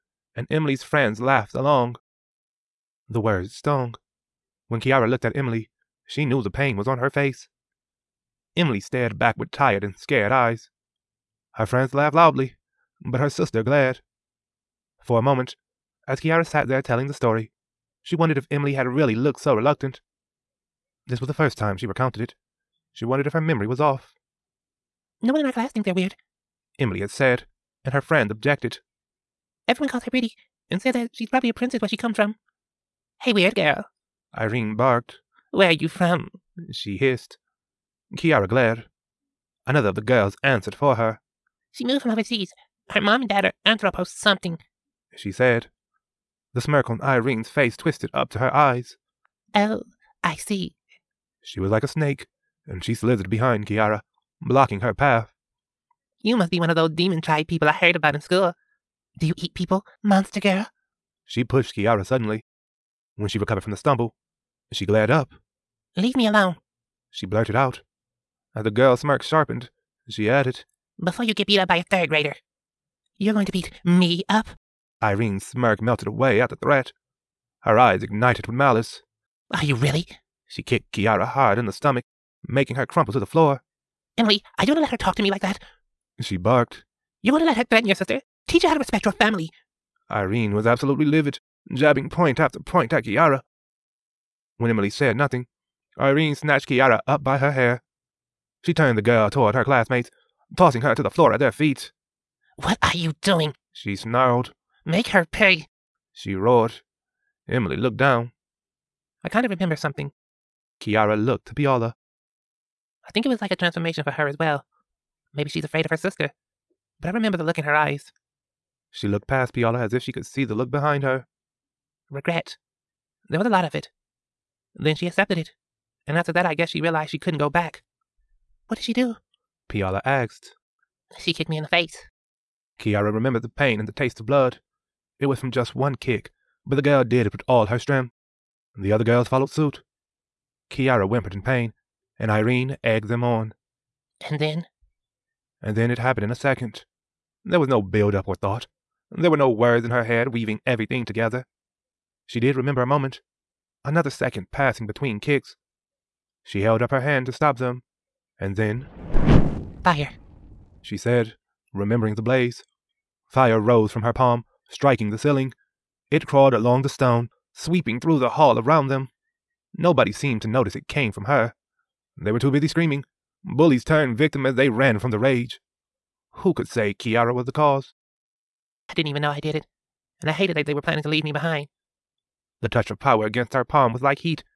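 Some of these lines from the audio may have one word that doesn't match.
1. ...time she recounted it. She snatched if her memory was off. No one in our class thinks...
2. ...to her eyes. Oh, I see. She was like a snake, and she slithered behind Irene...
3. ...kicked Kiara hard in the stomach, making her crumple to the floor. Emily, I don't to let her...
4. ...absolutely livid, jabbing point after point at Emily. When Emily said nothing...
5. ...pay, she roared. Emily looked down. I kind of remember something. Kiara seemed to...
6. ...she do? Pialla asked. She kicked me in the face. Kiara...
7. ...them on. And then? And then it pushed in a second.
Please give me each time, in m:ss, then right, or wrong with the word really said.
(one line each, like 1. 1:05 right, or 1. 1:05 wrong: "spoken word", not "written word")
1. 0:21 wrong: "wondered", not "snatched"
2. 0:48 wrong: "Kiara", not "Irene"
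3. 1:20 right
4. 1:30 wrong: "Kiara", not "Emily"
5. 1:45 wrong: "looked", not "seemed"
6. 2:08 right
7. 2:23 wrong: "happened", not "pushed".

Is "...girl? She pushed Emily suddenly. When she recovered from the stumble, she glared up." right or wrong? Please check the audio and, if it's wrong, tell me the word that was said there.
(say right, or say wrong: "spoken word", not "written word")
wrong: "Kiara", not "Emily".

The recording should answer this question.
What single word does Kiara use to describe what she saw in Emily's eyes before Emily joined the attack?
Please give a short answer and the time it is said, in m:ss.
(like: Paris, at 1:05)
Regret, at 2:02.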